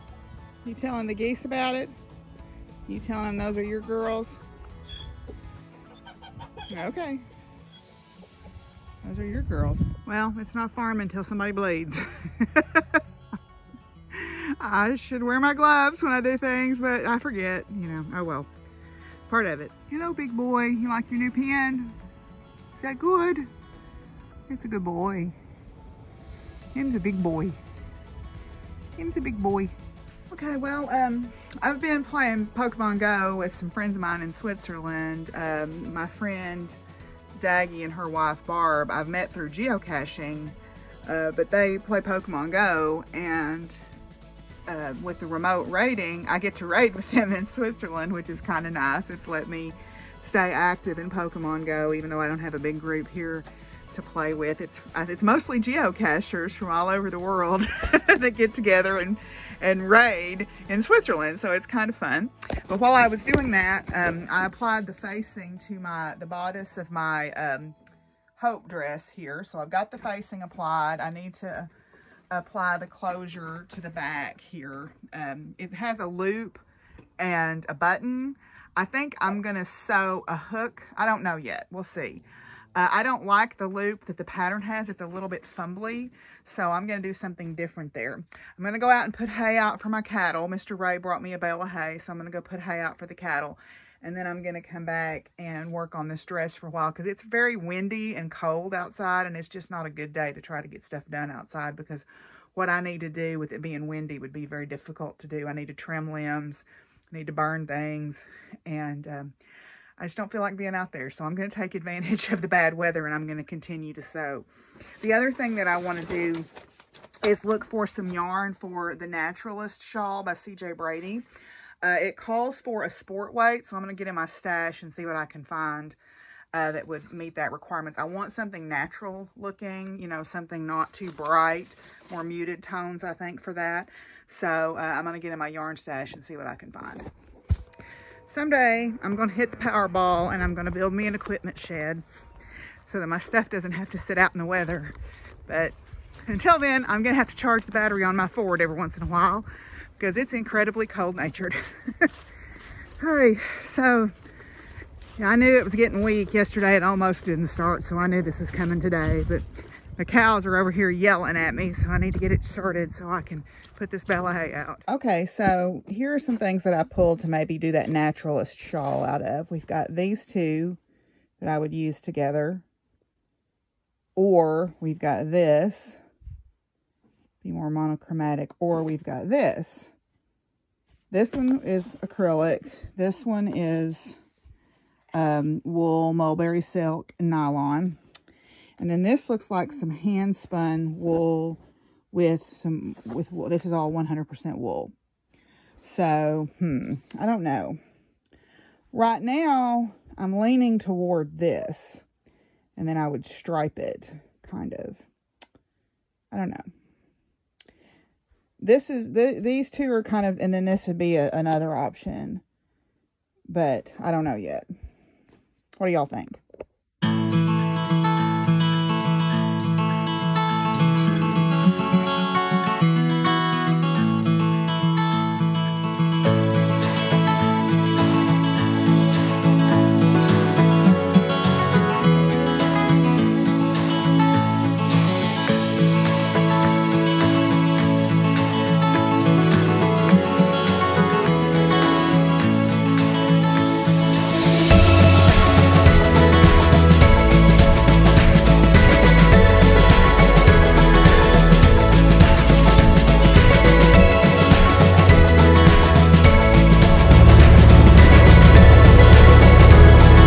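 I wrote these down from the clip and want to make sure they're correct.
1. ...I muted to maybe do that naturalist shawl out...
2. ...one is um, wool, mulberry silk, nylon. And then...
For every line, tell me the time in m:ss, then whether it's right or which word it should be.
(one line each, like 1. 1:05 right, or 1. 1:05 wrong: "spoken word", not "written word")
1. 2:46 wrong: "pulled", not "muted"
2. 3:03 right.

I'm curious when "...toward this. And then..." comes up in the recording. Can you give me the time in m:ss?
3:20.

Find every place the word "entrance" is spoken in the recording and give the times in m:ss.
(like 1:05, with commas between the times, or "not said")
not said.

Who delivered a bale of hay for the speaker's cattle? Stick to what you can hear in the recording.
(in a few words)
Mr. Ray.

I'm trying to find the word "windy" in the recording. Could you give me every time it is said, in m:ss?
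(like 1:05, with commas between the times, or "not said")
1:37, 1:43.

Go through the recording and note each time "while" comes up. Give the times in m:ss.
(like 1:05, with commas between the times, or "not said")
1:02, 1:36, 2:29.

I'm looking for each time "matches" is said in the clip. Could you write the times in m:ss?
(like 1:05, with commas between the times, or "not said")
not said.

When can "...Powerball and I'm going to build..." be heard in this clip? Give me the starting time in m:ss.
2:19.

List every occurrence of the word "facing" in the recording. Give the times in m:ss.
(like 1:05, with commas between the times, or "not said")
1:04, 1:09.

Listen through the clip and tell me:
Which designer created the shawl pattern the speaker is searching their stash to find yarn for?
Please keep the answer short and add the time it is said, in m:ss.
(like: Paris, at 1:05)
CJ Brady, at 2:00.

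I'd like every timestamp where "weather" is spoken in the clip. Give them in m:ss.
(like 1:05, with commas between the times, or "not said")
1:52, 2:24.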